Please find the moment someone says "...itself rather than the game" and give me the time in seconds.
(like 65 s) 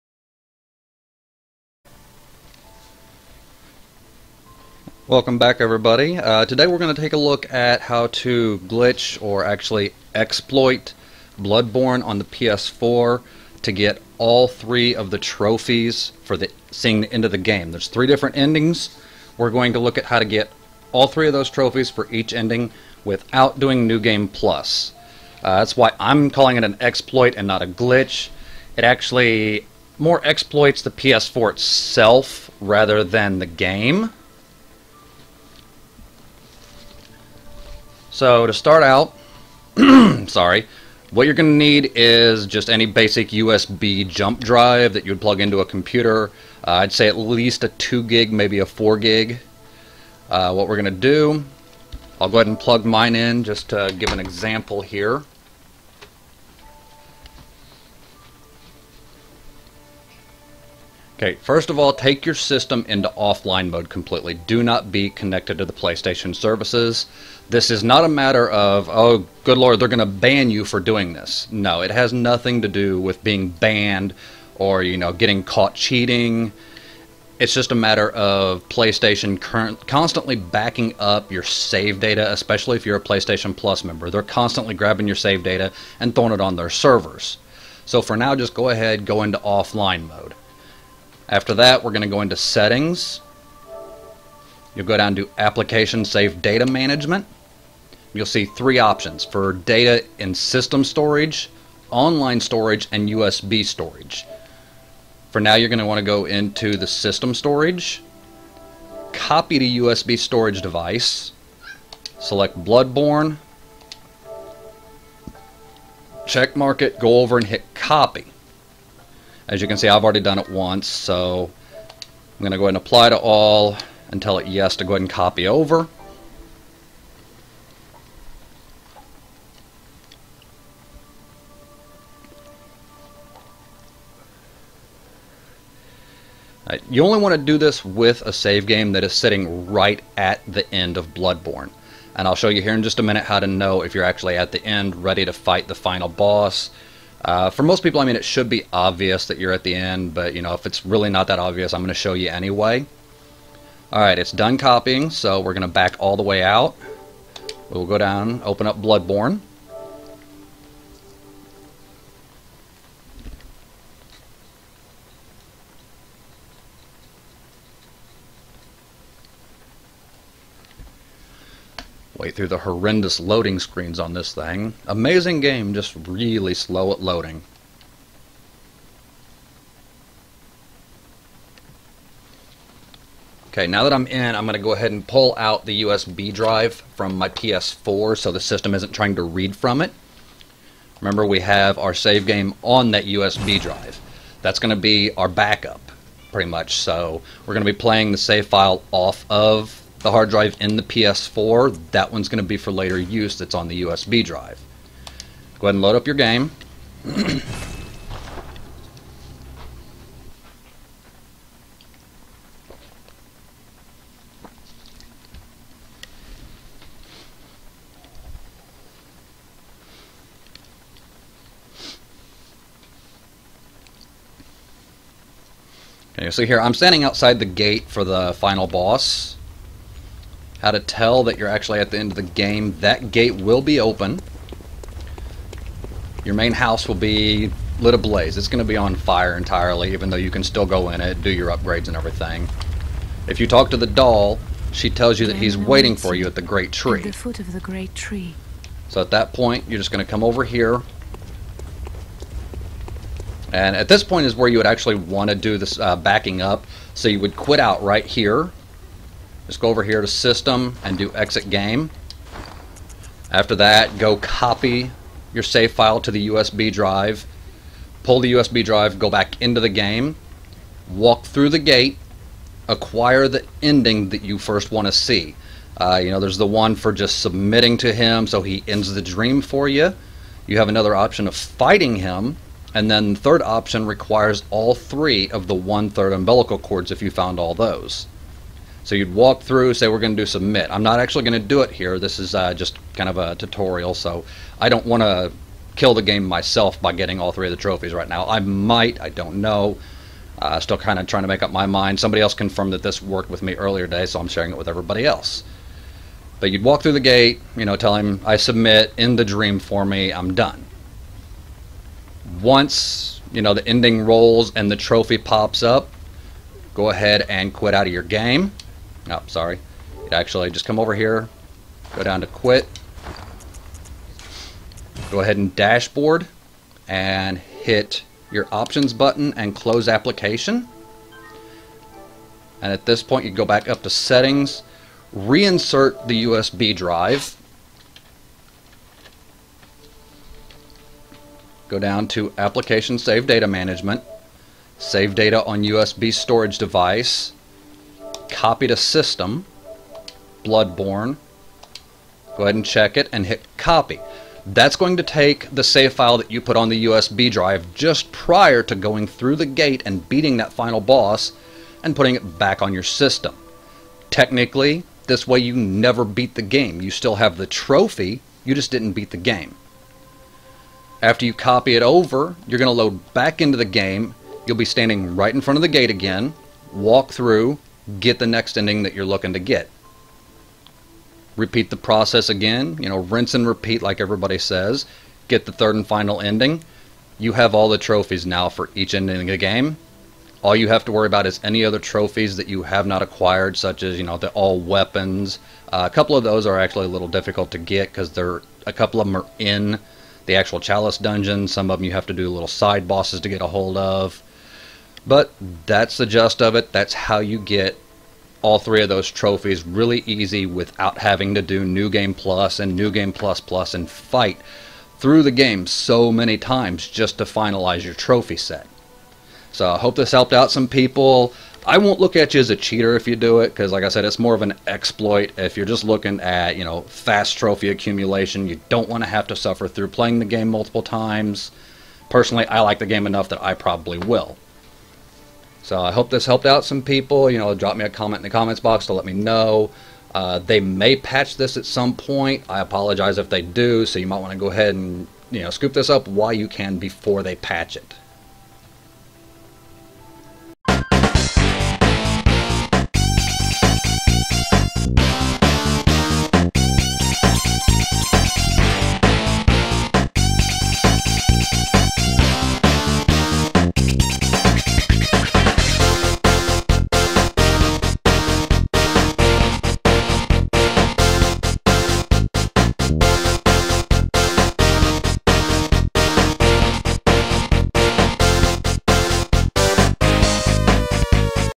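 31 s.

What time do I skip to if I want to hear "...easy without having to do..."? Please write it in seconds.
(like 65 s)
410 s.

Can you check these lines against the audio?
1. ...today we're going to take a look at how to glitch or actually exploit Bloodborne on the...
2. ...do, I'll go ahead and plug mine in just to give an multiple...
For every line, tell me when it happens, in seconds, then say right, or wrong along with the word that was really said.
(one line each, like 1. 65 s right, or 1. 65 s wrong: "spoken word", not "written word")
1. 6 s right
2. 51 s wrong: "example", not "multiple".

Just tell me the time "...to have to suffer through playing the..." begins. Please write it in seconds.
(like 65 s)
429 s.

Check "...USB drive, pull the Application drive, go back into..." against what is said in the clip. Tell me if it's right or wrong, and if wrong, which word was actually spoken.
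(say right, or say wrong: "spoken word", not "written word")
wrong: "USB", not "Application".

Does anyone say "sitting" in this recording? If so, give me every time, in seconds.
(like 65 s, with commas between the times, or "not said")
139 s.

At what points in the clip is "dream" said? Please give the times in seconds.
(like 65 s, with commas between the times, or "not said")
279 s, 309 s.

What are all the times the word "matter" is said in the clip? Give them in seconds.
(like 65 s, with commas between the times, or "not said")
68 s, 77 s.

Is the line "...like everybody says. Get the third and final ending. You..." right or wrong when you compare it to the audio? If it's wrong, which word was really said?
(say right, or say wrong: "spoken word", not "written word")
right.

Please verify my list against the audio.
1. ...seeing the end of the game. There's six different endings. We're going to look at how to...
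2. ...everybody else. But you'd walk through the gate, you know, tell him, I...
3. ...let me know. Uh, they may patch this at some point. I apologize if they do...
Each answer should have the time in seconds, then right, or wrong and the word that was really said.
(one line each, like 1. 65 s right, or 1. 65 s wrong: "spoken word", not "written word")
1. 16 s wrong: "three", not "six"
2. 304 s right
3. 438 s right.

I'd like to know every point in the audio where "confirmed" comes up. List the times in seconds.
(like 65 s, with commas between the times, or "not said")
302 s.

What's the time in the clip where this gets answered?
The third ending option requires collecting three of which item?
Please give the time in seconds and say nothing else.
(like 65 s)
285 s.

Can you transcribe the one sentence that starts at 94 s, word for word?
You'll go down to Application save Data Management.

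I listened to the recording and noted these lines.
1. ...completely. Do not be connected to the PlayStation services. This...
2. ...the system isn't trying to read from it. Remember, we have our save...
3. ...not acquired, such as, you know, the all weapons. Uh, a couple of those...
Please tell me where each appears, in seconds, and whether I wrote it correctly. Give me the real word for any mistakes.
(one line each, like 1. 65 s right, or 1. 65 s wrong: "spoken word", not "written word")
1. 63 s right
2. 188 s right
3. 392 s right.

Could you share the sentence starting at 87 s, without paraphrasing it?
So for now, just go ahead, go into offline mode.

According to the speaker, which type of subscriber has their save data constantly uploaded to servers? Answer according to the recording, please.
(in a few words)
PlayStation Plus member.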